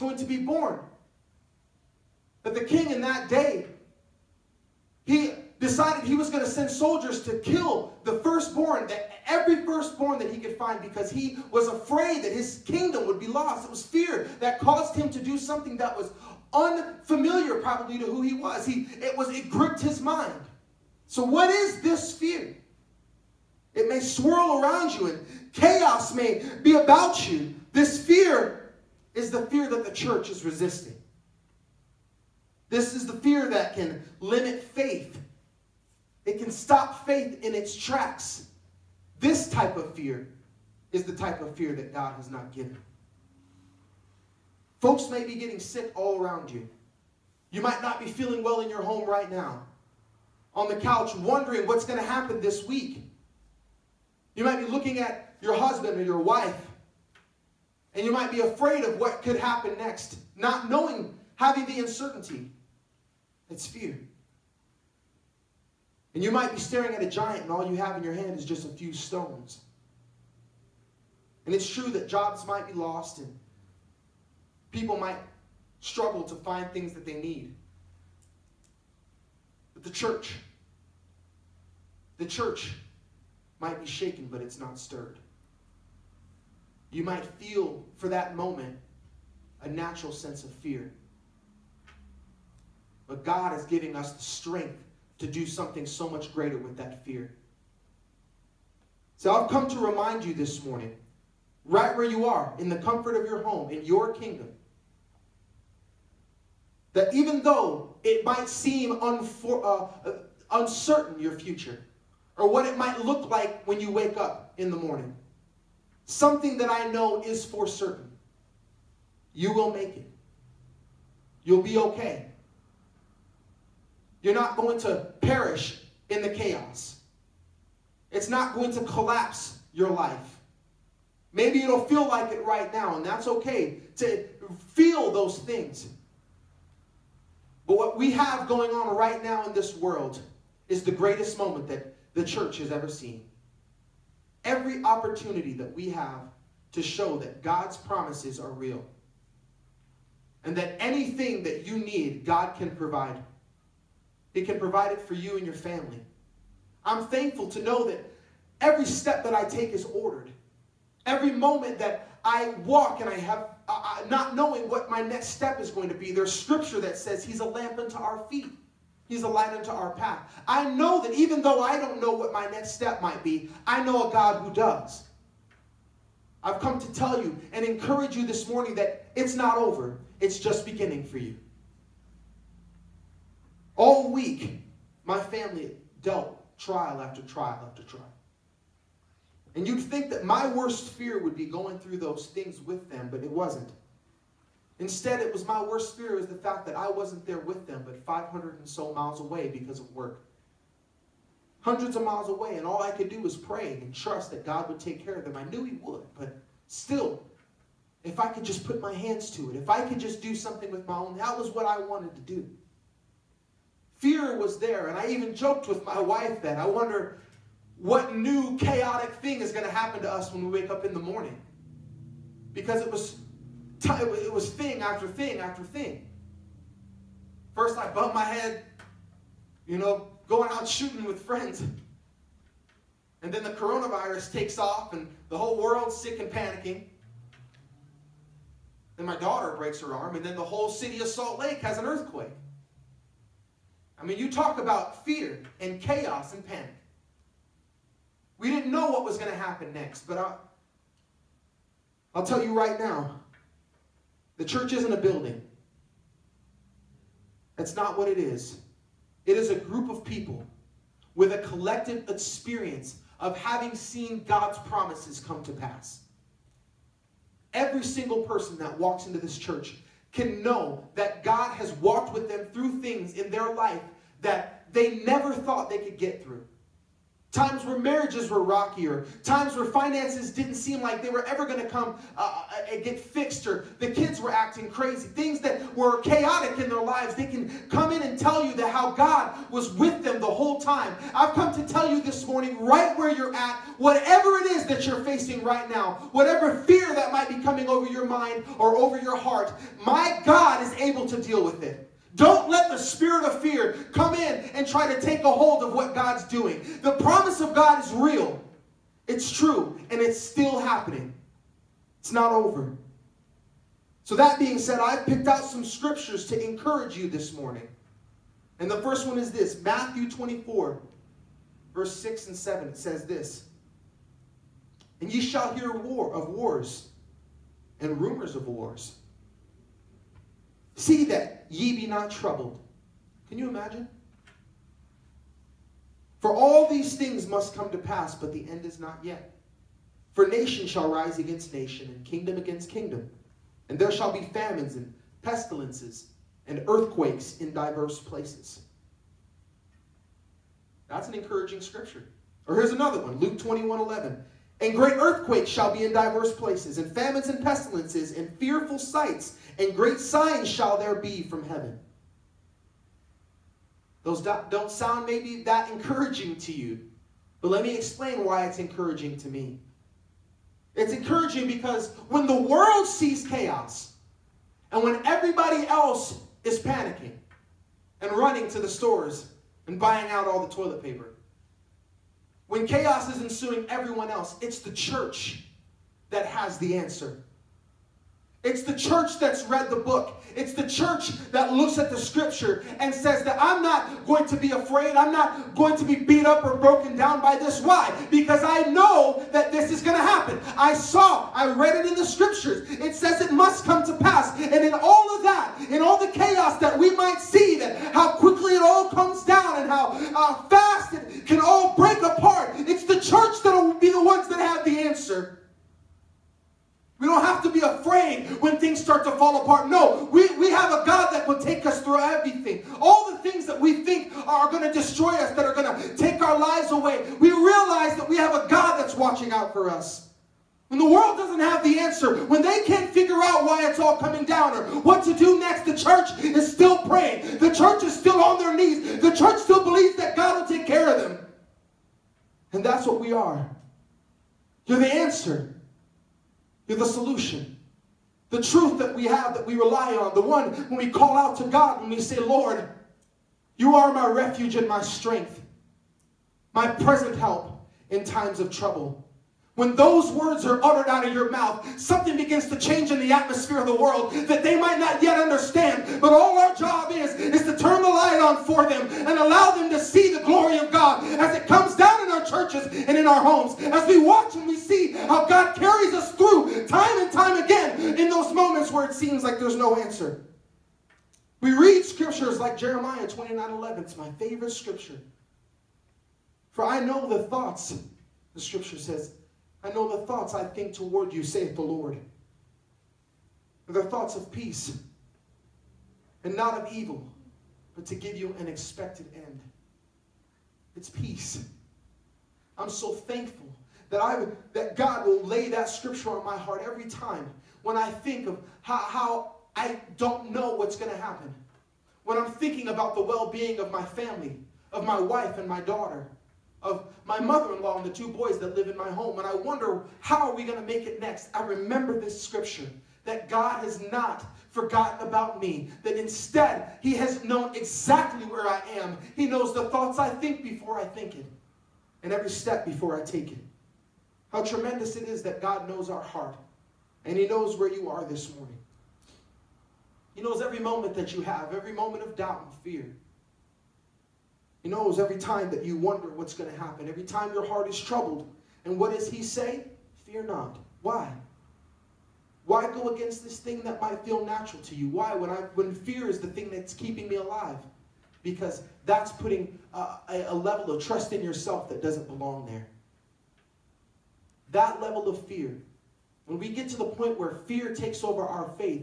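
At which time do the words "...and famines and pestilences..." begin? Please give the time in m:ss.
5:56.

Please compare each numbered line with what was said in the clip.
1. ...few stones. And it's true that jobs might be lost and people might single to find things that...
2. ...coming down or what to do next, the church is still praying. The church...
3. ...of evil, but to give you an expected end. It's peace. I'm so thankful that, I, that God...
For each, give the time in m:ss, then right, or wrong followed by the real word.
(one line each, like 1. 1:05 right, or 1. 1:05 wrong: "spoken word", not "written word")
1. 1:08 wrong: "struggle", not "single"
2. 7:13 right
3. 8:16 right.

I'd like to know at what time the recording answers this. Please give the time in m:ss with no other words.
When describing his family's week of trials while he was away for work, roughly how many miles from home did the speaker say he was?
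3:18.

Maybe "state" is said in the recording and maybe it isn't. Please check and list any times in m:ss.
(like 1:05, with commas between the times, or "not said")
not said.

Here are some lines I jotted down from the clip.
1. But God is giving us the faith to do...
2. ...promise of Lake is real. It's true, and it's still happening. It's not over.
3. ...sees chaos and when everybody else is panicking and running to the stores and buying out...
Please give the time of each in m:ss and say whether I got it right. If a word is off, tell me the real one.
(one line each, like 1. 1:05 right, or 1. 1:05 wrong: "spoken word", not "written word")
1. 1:33 wrong: "strength", not "faith"
2. 5:06 wrong: "God", not "Lake"
3. 6:12 right.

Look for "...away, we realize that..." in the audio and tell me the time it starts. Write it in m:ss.
7:06.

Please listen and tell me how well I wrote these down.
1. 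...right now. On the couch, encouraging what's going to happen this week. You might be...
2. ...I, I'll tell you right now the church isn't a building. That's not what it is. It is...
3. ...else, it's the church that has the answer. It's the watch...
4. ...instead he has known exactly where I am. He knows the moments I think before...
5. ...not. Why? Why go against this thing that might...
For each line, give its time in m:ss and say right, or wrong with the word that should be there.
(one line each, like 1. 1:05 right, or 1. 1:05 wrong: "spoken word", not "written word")
1. 0:49 wrong: "wondering", not "encouraging"
2. 4:10 right
3. 6:24 wrong: "church", not "watch"
4. 8:45 wrong: "thoughts", not "moments"
5. 9:10 right.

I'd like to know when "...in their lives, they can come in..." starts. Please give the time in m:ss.
4:46.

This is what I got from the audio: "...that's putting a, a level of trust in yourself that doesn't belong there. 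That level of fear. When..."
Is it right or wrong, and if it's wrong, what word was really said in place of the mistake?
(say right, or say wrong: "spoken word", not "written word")
right.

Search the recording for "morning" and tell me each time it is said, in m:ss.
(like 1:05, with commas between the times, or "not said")
1:40, 1:54, 2:58, 3:40, 4:52, 5:17, 8:58.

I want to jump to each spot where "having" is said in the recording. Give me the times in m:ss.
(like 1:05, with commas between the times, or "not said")
1:01, 4:23.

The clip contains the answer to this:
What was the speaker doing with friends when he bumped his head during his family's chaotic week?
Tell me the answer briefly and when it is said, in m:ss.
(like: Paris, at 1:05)
shooting, at 3:50.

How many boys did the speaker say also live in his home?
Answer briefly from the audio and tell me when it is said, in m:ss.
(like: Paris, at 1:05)
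2, at 8:37.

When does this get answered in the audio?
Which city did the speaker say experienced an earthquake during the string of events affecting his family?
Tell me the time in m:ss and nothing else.
4:01.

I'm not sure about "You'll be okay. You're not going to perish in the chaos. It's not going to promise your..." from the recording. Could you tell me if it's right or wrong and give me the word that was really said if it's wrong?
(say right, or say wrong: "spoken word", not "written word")
wrong: "collapse", not "promise".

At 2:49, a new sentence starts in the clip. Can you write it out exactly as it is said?
He's a light unto our path.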